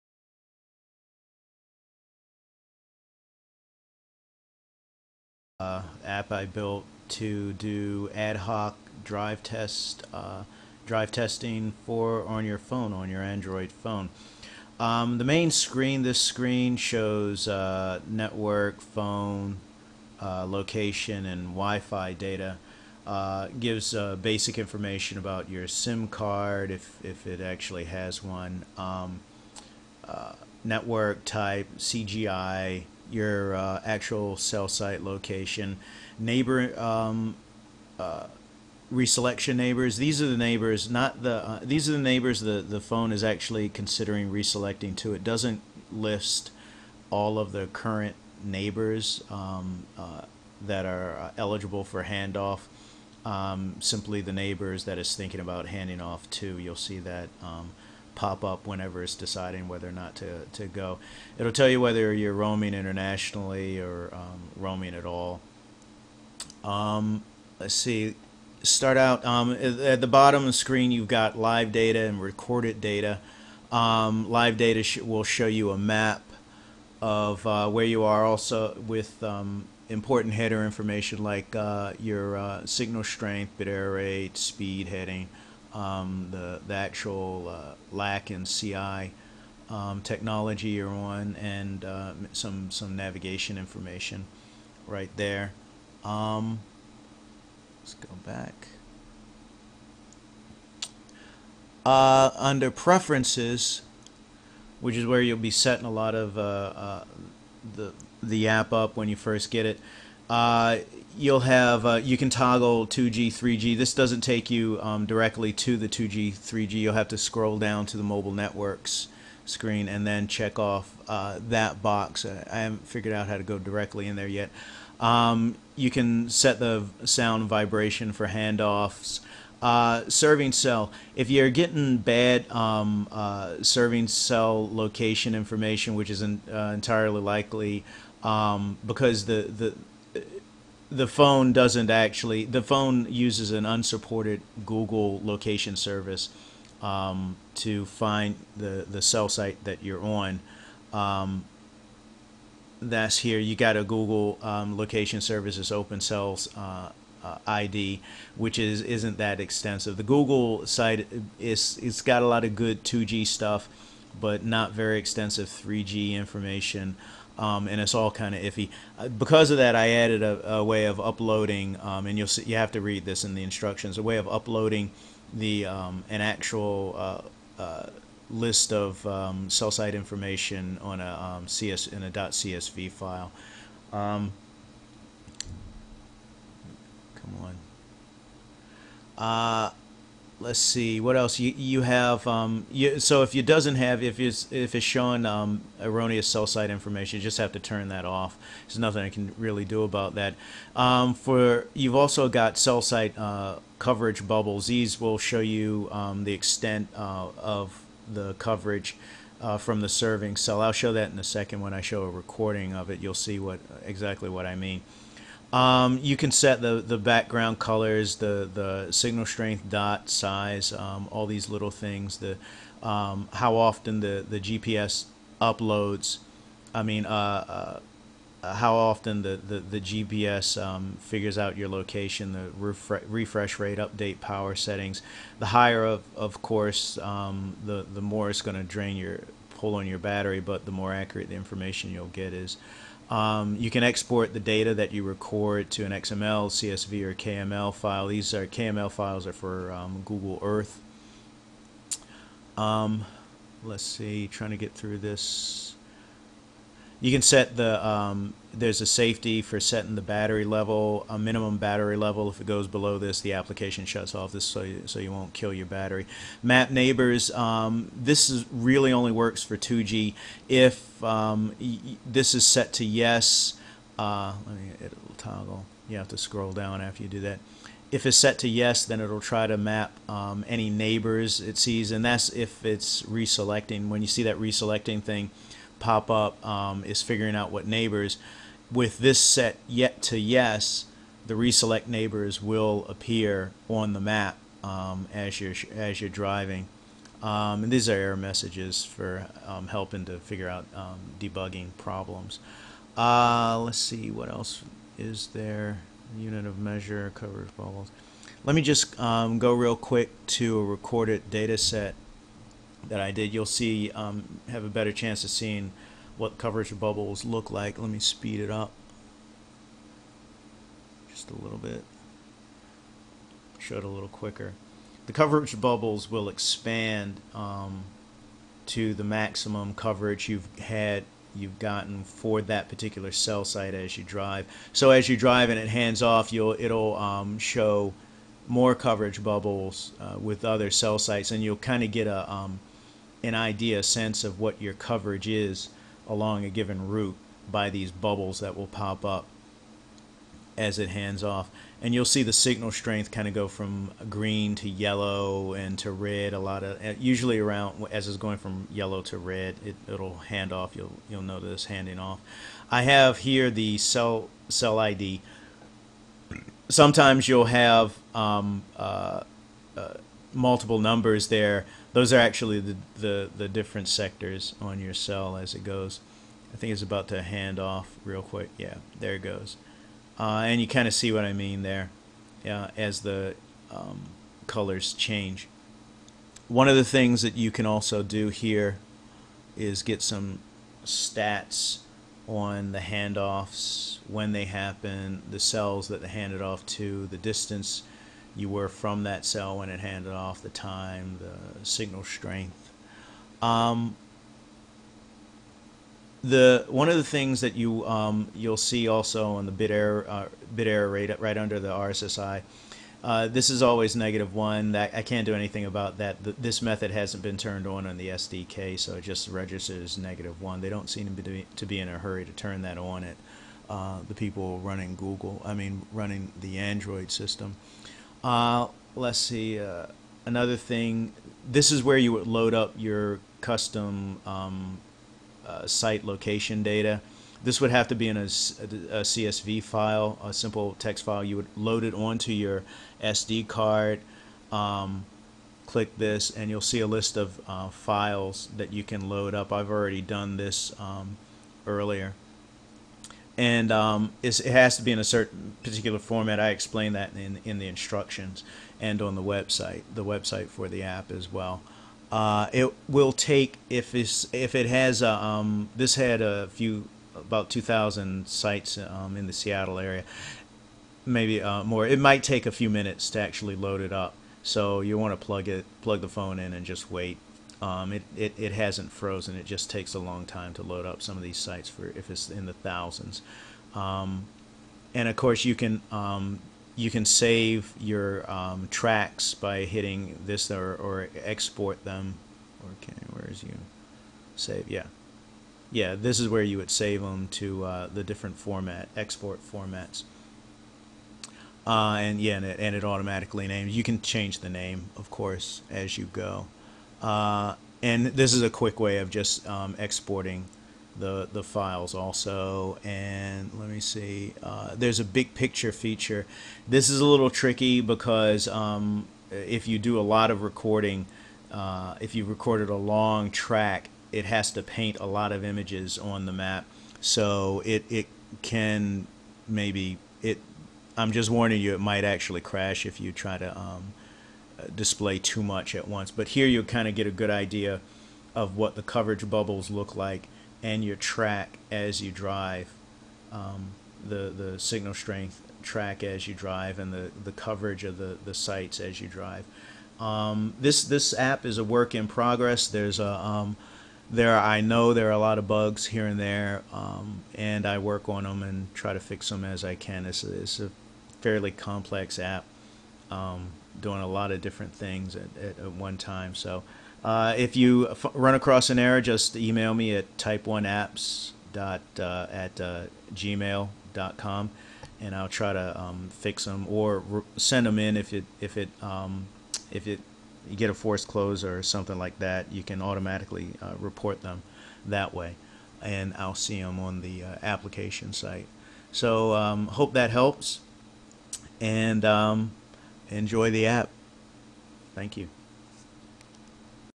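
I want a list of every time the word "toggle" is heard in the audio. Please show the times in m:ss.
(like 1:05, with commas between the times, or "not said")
1:52, 4:35.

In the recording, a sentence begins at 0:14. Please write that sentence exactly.
Um, the main screen this screen shows uh, network phone uh, location and Wi-Fi data.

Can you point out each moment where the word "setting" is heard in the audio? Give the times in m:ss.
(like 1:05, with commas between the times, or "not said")
1:45, 3:54, 4:19.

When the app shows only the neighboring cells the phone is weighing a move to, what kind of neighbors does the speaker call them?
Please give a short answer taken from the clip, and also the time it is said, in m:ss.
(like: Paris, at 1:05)
Reselection neighbors, at 0:38.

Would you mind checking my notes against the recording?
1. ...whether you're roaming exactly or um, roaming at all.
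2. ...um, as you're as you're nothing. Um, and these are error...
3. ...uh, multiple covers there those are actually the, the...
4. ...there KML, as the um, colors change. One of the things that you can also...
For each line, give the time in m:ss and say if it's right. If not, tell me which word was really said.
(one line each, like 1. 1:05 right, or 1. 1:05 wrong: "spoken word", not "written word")
1. 1:01 wrong: "internationally", not "exactly"
2. 4:54 wrong: "driving", not "nothing"
3. 6:09 wrong: "numbers", not "covers"
4. 6:21 wrong: "Yeah", not "KML".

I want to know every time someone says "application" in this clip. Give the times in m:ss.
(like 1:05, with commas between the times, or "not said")
4:23, 9:47.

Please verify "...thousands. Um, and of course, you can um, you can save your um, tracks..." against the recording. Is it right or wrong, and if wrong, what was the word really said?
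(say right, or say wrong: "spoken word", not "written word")
right.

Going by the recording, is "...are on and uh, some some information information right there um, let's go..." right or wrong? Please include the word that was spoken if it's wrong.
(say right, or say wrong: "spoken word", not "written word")
wrong: "navigation", not "information".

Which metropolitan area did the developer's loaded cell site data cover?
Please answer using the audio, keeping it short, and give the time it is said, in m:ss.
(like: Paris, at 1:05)
Seattle, at 7:49.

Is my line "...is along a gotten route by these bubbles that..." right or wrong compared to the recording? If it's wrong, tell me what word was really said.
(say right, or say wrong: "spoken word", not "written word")
wrong: "given", not "gotten".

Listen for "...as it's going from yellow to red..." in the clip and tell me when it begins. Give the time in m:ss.
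5:57.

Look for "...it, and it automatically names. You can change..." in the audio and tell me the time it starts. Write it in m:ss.
8:22.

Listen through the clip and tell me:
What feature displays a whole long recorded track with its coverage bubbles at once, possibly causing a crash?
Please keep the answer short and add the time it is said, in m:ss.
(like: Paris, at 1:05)
Big picture, at 8:35.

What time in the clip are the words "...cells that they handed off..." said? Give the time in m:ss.
6:35.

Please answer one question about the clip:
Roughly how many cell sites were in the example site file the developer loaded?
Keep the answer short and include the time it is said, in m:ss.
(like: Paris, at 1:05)
2,000, at 7:47.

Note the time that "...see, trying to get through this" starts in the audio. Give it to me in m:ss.
4:13.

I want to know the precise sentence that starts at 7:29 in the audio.
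I've already done this um, earlier and um, it has to be in a certain particular format.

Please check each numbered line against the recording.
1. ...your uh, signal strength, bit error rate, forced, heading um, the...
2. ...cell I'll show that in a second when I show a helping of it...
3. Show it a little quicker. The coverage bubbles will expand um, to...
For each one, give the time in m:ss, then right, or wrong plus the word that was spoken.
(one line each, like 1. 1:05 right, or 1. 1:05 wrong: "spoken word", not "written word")
1. 1:21 wrong: "speed", not "forced"
2. 3:30 wrong: "recording", not "helping"
3. 5:23 right.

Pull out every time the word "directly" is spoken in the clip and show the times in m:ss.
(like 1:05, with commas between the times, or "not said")
1:55, 2:03.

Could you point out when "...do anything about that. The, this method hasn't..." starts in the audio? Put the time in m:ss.
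6:55.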